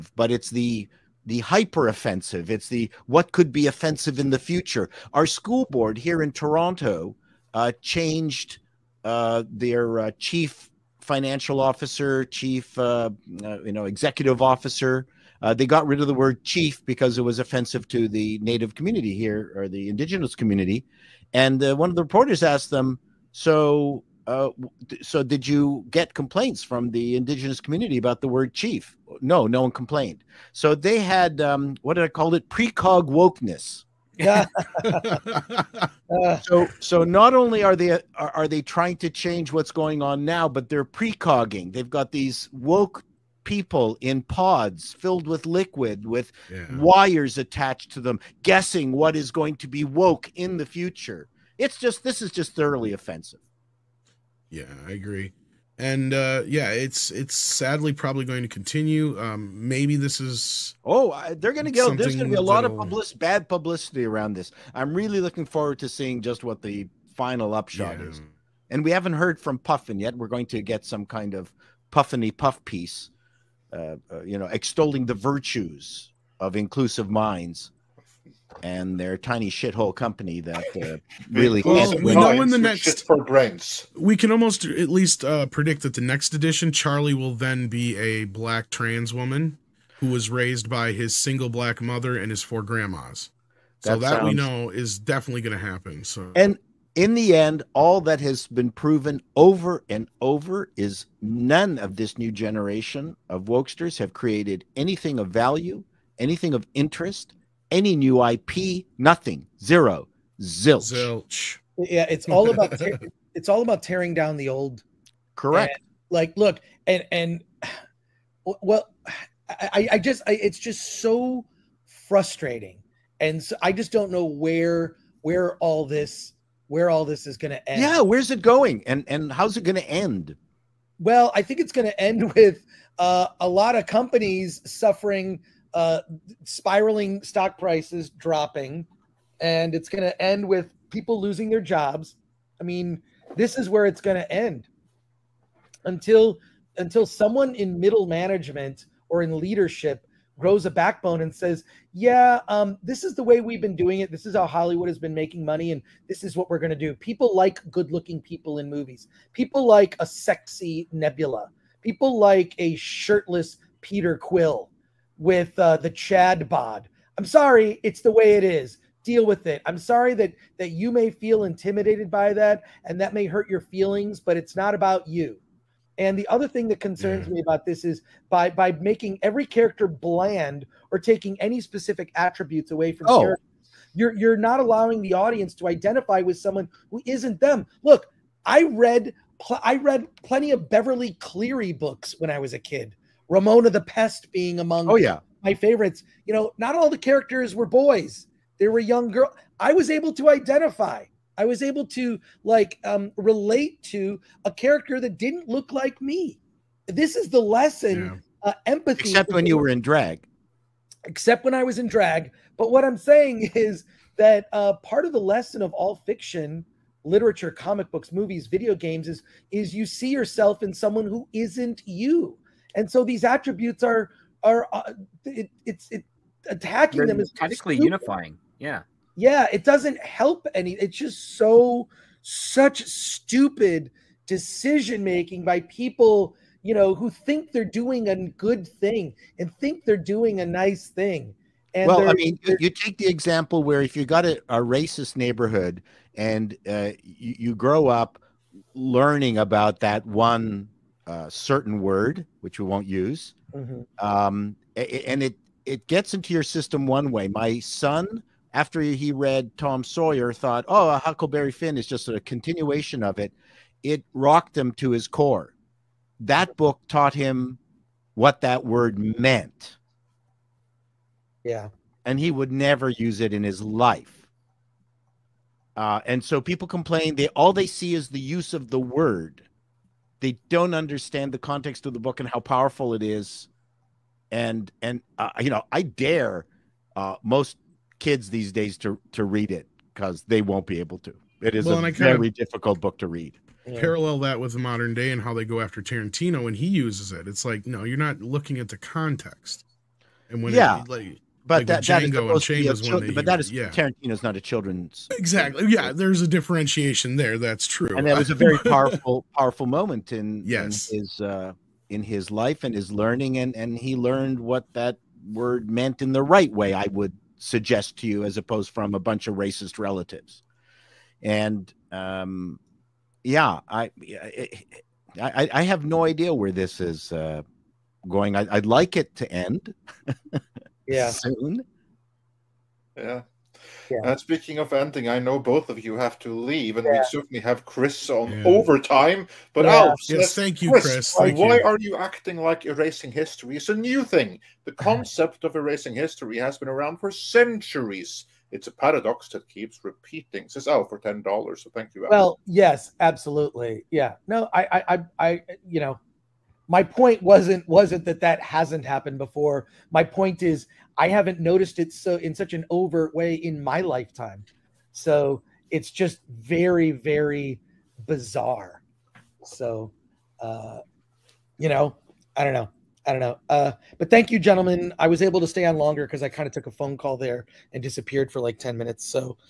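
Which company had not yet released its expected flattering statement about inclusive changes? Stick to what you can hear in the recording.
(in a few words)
Puffin.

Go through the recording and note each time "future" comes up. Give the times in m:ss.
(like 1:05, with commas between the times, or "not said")
0:04, 0:50.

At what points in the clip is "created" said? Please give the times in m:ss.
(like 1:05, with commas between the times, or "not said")
1:44.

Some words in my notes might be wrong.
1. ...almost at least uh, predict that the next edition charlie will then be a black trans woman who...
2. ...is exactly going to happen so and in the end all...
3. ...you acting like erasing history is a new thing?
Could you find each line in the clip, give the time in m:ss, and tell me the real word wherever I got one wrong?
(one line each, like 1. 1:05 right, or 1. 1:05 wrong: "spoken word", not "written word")
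1. 1:24 right
2. 1:34 wrong: "definitely", not "exactly"
3. 5:41 right.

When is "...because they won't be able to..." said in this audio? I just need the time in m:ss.
4:49.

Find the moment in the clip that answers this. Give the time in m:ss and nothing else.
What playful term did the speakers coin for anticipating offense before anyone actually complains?
0:32.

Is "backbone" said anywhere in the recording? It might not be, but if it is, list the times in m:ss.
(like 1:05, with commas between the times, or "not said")
2:30.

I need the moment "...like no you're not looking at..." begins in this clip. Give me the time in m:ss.
4:57.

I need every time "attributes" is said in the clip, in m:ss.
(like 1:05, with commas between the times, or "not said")
3:02, 3:43.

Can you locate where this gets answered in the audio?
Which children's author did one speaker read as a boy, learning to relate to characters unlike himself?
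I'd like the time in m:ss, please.
3:10.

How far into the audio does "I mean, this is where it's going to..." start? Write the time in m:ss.
2:22.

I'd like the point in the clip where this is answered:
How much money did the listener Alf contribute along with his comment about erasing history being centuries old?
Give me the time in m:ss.
5:50.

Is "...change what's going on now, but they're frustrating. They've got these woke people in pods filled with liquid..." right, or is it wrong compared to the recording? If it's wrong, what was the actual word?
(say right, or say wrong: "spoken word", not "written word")
wrong: "precogging", not "frustrating".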